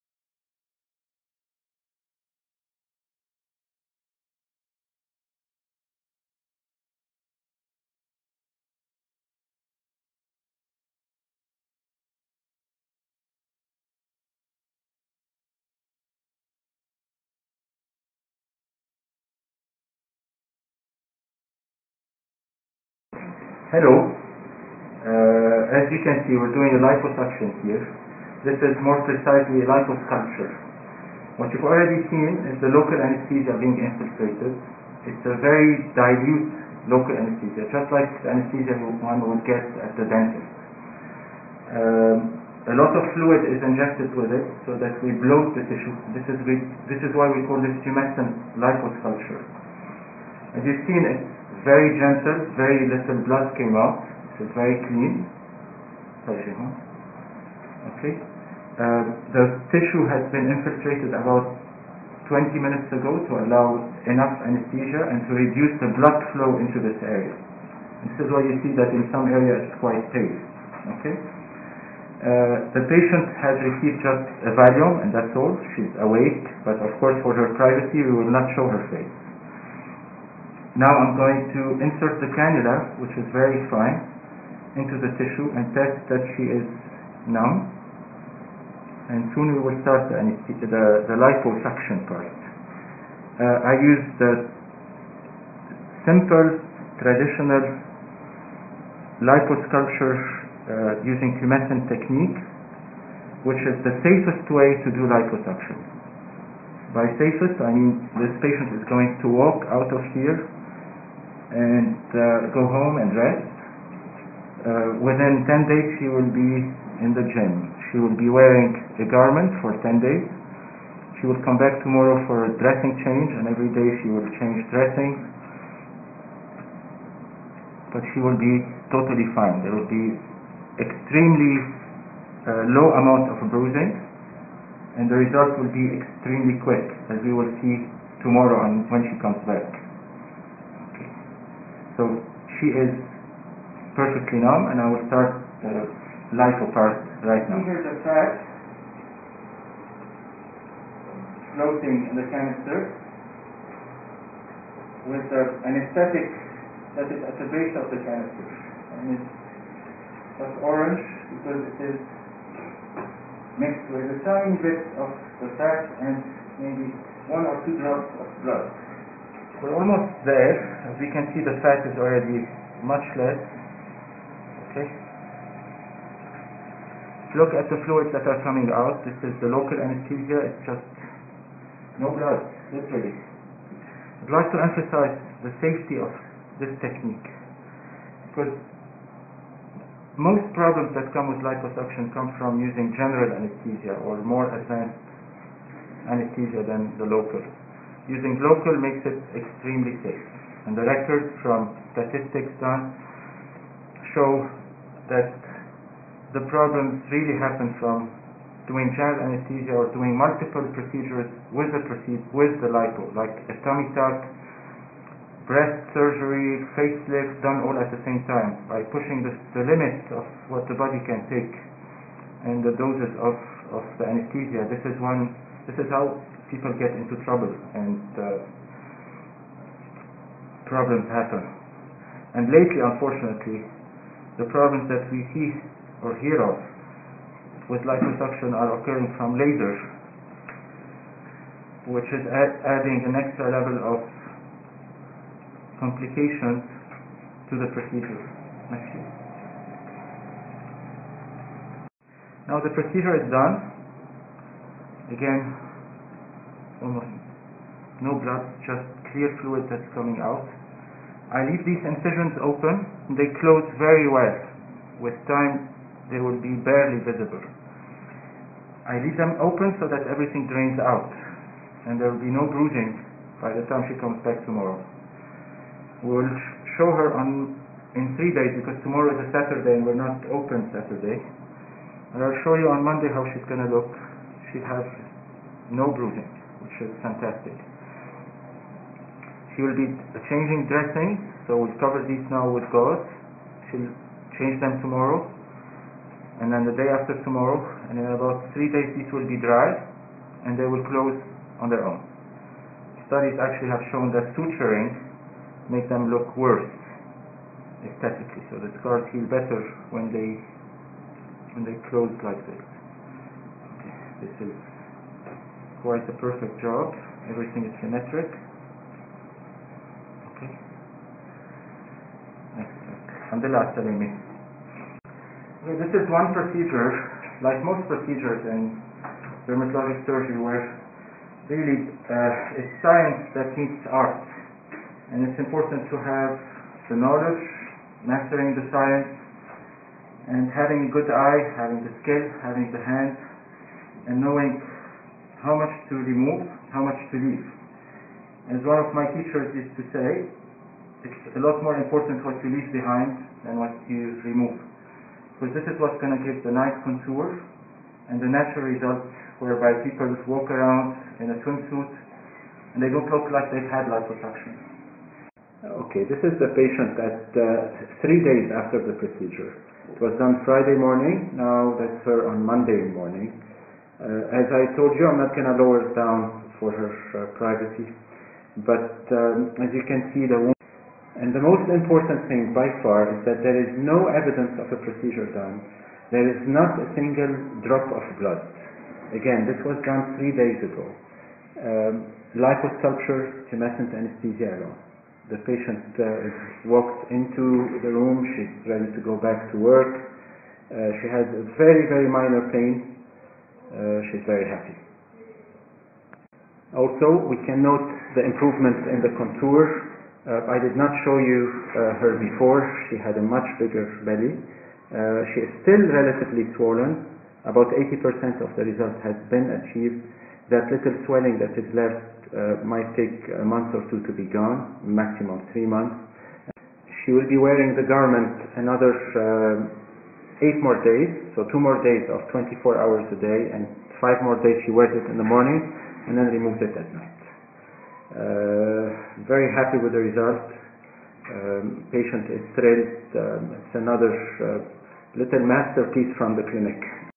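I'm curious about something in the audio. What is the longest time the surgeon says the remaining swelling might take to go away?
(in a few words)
3 months.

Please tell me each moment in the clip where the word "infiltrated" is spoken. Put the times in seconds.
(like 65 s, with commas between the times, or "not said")
33 s, 60 s.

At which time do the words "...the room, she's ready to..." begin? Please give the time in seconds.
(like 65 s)
397 s.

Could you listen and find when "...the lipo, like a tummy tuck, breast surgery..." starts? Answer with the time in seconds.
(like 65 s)
212 s.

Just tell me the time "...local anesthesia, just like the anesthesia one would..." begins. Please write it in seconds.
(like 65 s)
36 s.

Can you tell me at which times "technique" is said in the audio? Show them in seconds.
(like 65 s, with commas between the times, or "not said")
101 s, 186 s.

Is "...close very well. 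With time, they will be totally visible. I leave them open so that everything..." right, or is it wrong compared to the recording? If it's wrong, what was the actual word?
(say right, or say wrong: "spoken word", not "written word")
wrong: "barely", not "totally".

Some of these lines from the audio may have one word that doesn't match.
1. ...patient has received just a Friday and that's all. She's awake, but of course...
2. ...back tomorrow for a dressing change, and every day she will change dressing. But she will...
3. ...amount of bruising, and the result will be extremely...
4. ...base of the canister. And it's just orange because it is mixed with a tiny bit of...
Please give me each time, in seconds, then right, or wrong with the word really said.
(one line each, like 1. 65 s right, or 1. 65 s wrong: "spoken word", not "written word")
1. 72 s wrong: "Valium", not "Friday"
2. 121 s right
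3. 132 s right
4. 157 s right.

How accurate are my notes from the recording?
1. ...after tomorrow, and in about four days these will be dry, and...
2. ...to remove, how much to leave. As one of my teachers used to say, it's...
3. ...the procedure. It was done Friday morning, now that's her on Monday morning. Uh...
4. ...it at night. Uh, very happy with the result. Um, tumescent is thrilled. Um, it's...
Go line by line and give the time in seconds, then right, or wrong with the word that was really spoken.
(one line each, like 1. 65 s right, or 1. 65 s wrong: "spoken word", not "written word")
1. 296 s wrong: "three", not "four"
2. 345 s right
3. 368 s right
4. 436 s wrong: "patient", not "tumescent".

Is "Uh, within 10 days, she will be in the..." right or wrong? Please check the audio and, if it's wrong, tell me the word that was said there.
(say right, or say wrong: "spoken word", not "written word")
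right.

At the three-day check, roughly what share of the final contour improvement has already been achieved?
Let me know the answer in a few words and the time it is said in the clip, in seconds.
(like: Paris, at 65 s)
80%, at 417 s.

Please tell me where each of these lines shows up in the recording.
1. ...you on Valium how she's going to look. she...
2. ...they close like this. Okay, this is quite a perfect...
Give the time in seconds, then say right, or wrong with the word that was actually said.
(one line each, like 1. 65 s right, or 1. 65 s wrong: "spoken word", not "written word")
1. 282 s wrong: "Monday", not "Valium"
2. 311 s right.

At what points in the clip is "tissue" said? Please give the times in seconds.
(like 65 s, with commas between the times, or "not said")
45 s, 59 s, 85 s.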